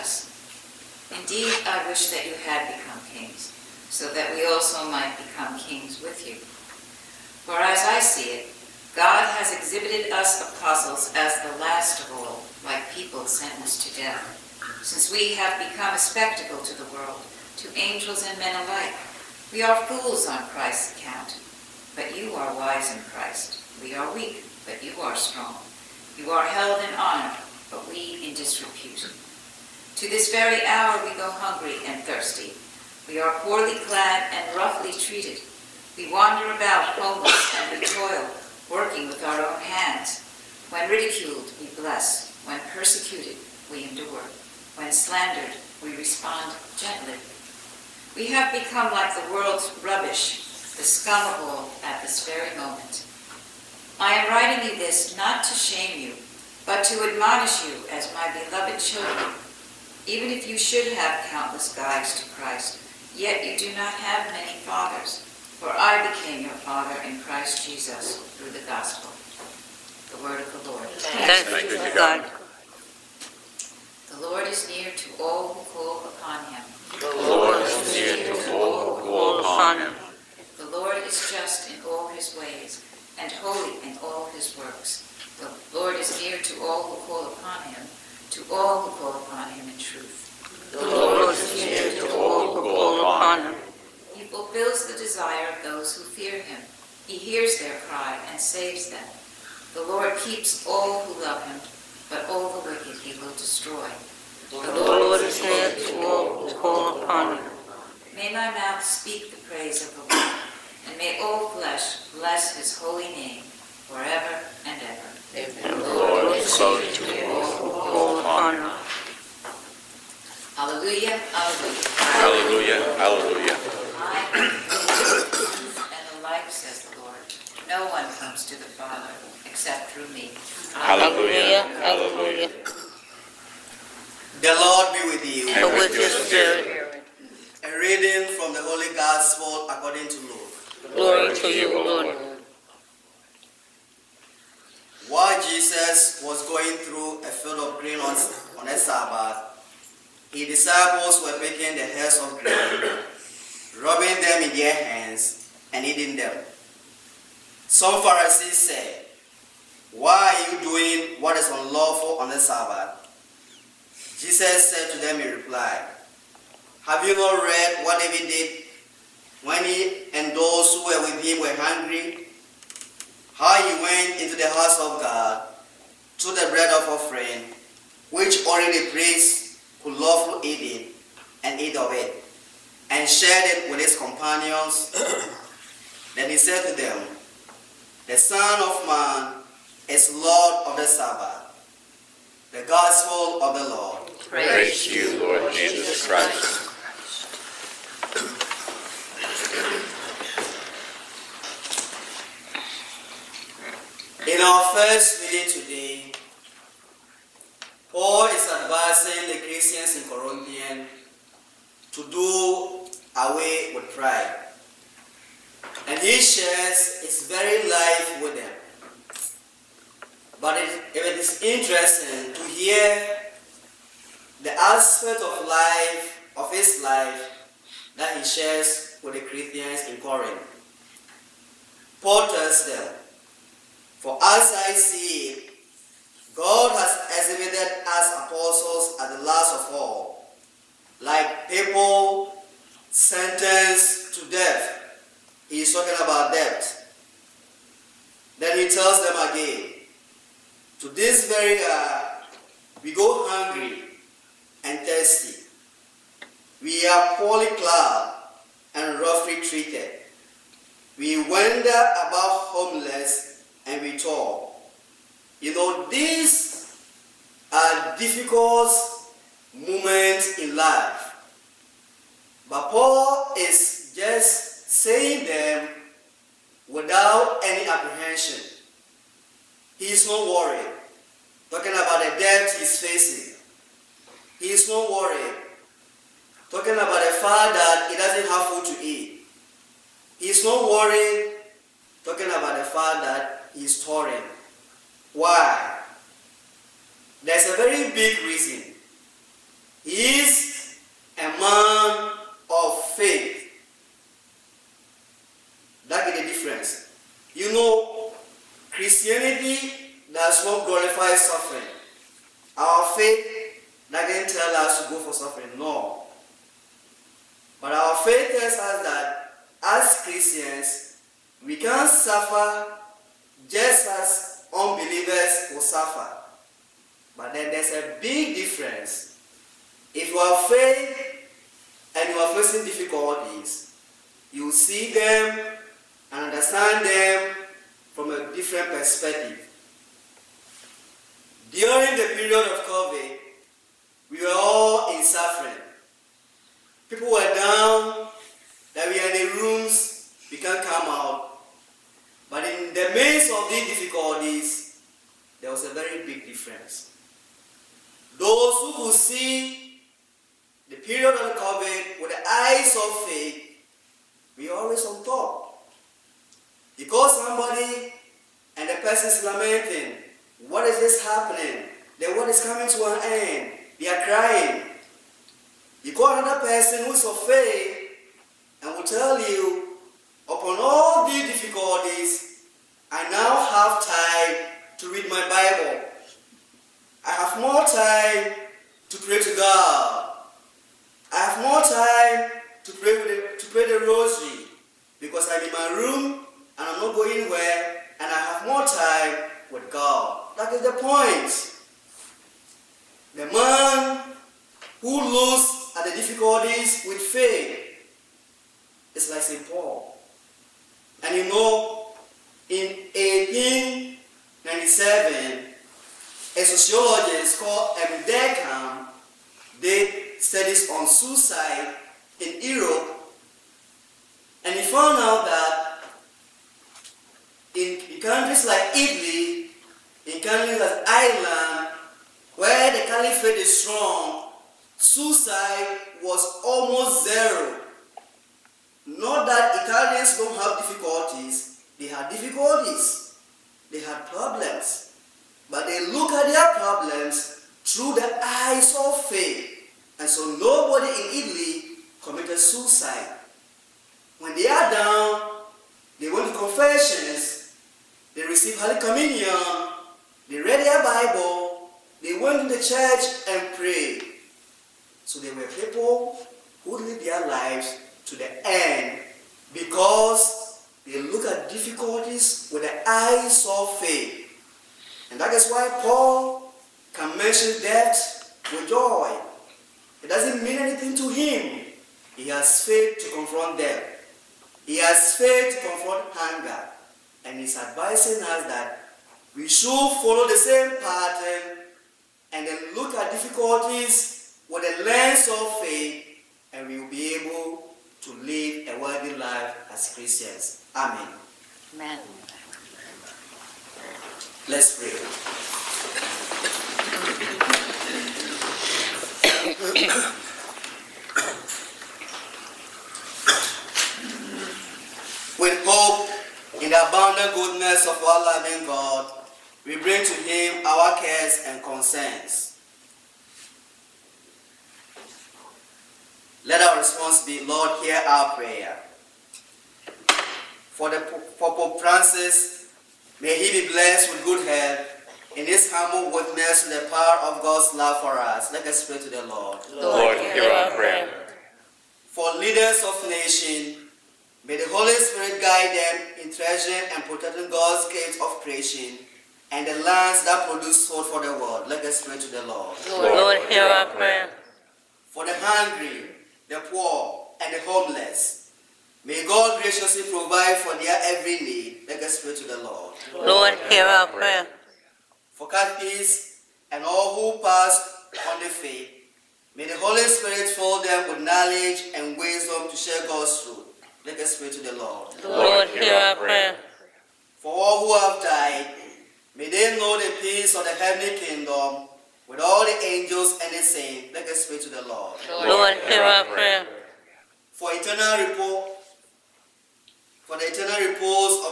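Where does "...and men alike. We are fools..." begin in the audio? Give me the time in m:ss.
0:18.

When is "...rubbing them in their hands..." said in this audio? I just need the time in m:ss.
2:33.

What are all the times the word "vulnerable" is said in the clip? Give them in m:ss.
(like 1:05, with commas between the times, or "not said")
not said.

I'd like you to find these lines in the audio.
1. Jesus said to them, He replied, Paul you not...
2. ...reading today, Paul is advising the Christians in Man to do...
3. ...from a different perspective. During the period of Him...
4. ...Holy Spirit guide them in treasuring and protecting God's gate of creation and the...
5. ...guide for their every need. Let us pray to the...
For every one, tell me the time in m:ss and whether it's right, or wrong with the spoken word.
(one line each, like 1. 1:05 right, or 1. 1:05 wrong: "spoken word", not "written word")
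1. 2:44 wrong: "Have", not "Paul"
2. 3:25 wrong: "Corinthian", not "Man"
3. 5:37 wrong: "COVID", not "Him"
4. 9:04 right
5. 9:20 wrong: "provide", not "guide".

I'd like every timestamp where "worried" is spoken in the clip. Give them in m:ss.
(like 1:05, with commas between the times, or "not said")
4:40, 4:44, 4:50.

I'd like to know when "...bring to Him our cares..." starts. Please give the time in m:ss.
8:39.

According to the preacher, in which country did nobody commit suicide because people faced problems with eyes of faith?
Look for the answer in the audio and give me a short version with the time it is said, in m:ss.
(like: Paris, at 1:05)
Italy, at 7:31.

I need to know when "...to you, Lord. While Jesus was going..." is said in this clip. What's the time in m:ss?
2:21.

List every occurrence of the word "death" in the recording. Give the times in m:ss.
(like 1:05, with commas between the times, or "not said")
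0:14, 4:04, 7:57, 8:03.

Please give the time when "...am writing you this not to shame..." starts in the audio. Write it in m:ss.
0:54.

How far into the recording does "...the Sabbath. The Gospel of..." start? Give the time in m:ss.
3:10.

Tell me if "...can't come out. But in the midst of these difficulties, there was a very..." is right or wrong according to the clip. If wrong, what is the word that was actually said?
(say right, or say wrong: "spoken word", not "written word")
right.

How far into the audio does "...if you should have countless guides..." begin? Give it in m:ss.
1:00.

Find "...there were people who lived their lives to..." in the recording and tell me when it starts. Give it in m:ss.
7:45.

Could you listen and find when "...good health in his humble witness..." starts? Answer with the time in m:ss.
8:54.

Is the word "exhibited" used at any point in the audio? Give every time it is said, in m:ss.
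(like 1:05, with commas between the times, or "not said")
0:09, 3:57.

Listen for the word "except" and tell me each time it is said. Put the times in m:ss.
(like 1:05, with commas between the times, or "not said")
2:09.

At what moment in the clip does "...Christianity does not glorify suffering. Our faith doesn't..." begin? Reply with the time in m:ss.
5:08.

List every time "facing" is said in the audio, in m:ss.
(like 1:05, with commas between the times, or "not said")
4:42, 5:32.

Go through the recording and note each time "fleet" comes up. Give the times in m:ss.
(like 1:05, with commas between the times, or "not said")
not said.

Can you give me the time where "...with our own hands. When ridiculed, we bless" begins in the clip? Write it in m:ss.
0:39.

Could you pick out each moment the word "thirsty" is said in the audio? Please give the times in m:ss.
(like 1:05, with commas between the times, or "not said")
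0:32, 4:14.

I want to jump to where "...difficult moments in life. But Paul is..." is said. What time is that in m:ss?
4:27.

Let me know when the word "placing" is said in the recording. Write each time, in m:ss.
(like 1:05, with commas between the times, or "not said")
not said.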